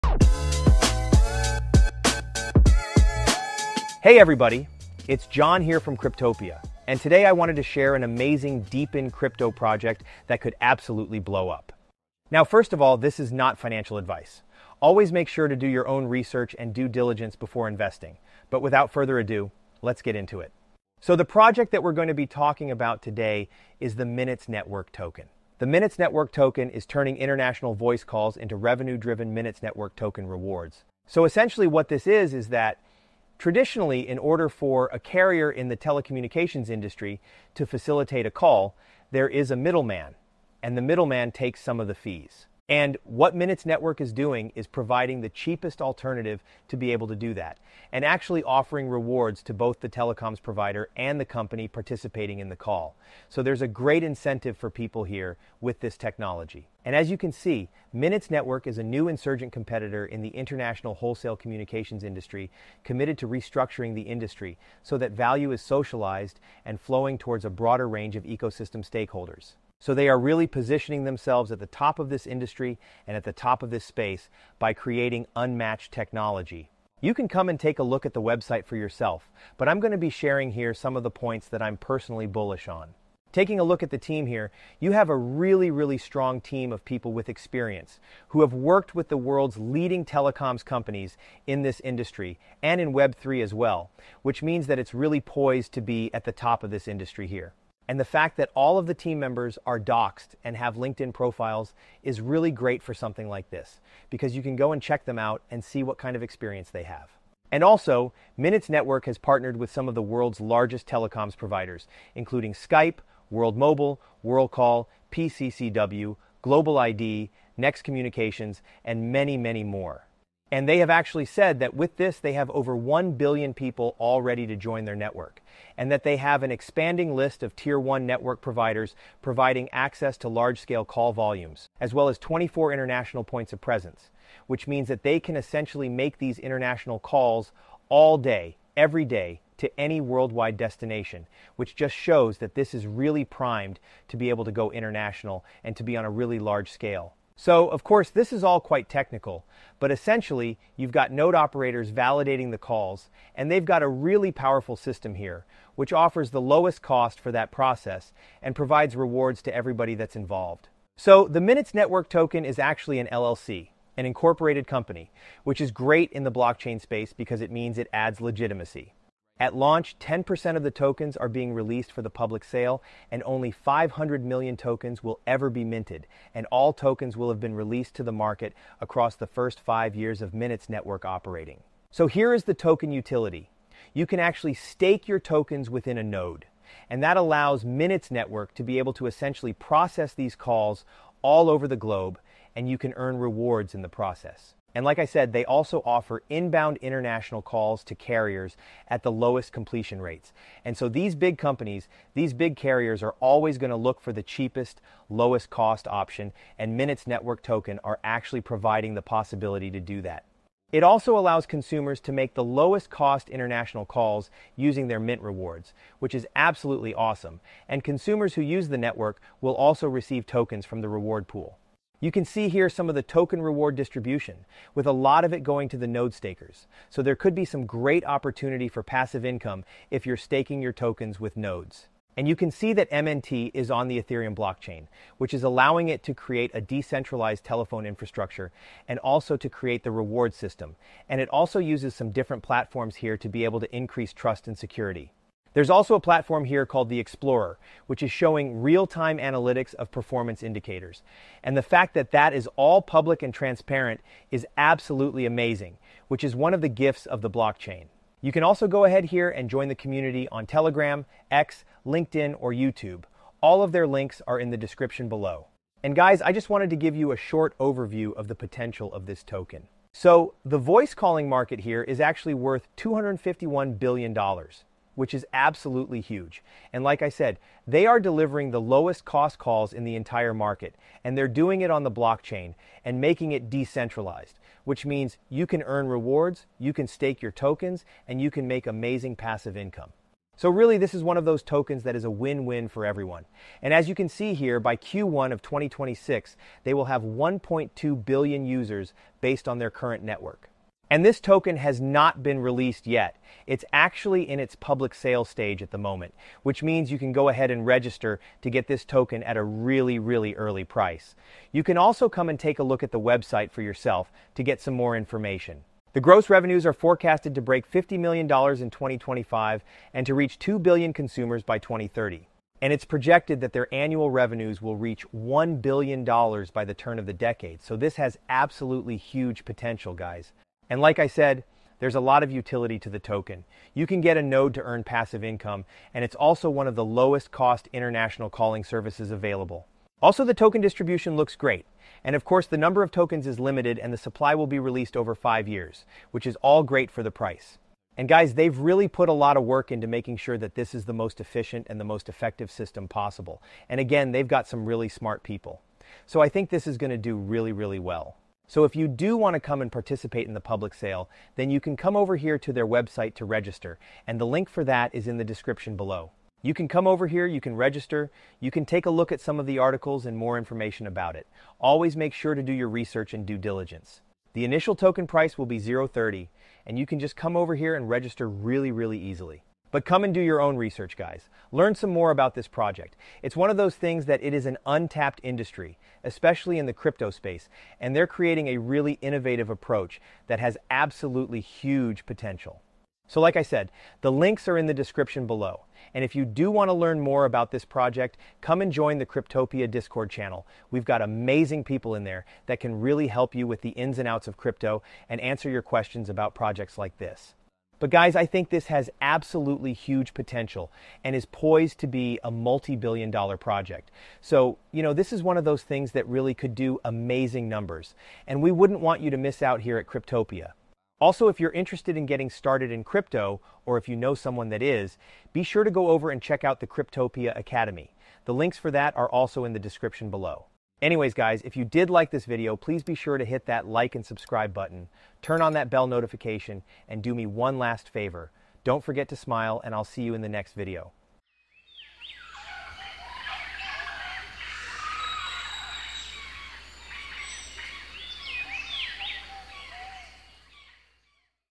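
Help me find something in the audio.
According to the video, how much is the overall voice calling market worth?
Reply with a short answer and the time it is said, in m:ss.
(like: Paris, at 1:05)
$251 billion, at 4:32.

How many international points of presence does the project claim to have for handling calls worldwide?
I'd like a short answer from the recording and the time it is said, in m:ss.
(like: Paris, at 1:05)
24, at 2:12.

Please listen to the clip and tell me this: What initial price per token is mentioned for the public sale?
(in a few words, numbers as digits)
0.30.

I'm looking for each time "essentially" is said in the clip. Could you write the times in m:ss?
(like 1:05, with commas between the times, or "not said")
0:31, 2:15, 2:29, 3:09.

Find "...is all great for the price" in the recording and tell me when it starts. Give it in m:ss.
5:46.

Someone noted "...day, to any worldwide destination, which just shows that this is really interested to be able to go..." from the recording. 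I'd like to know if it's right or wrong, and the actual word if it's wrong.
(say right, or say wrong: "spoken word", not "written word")
wrong: "primed", not "interested".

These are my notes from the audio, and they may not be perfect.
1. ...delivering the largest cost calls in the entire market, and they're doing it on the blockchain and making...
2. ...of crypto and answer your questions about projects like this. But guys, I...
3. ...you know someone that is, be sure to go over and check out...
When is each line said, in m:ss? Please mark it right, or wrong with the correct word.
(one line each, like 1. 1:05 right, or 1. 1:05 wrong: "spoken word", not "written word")
1. 4:37 wrong: "lowest", not "largest"
2. 6:44 right
3. 7:03 right.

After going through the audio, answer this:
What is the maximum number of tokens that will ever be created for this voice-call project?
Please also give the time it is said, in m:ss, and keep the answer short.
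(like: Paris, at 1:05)
500 million, at 2:53.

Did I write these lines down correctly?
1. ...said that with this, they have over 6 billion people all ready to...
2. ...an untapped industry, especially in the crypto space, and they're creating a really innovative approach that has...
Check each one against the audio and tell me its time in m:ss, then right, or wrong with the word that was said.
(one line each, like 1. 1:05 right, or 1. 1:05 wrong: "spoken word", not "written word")
1. 2:01 wrong: "1", not "6"
2. 6:24 right.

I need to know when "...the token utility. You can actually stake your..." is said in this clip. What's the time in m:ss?
3:02.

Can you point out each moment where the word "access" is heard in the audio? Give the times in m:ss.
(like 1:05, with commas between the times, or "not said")
2:09.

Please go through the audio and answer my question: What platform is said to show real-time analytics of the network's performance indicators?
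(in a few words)
the Explorer.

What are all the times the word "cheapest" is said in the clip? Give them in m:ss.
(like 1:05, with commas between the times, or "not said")
0:45, 3:24.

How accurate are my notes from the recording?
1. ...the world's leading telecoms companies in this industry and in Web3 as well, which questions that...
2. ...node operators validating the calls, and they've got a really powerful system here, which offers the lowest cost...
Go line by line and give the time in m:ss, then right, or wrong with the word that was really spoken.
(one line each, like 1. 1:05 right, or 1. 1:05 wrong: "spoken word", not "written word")
1. 1:29 wrong: "means", not "questions"
2. 2:31 right.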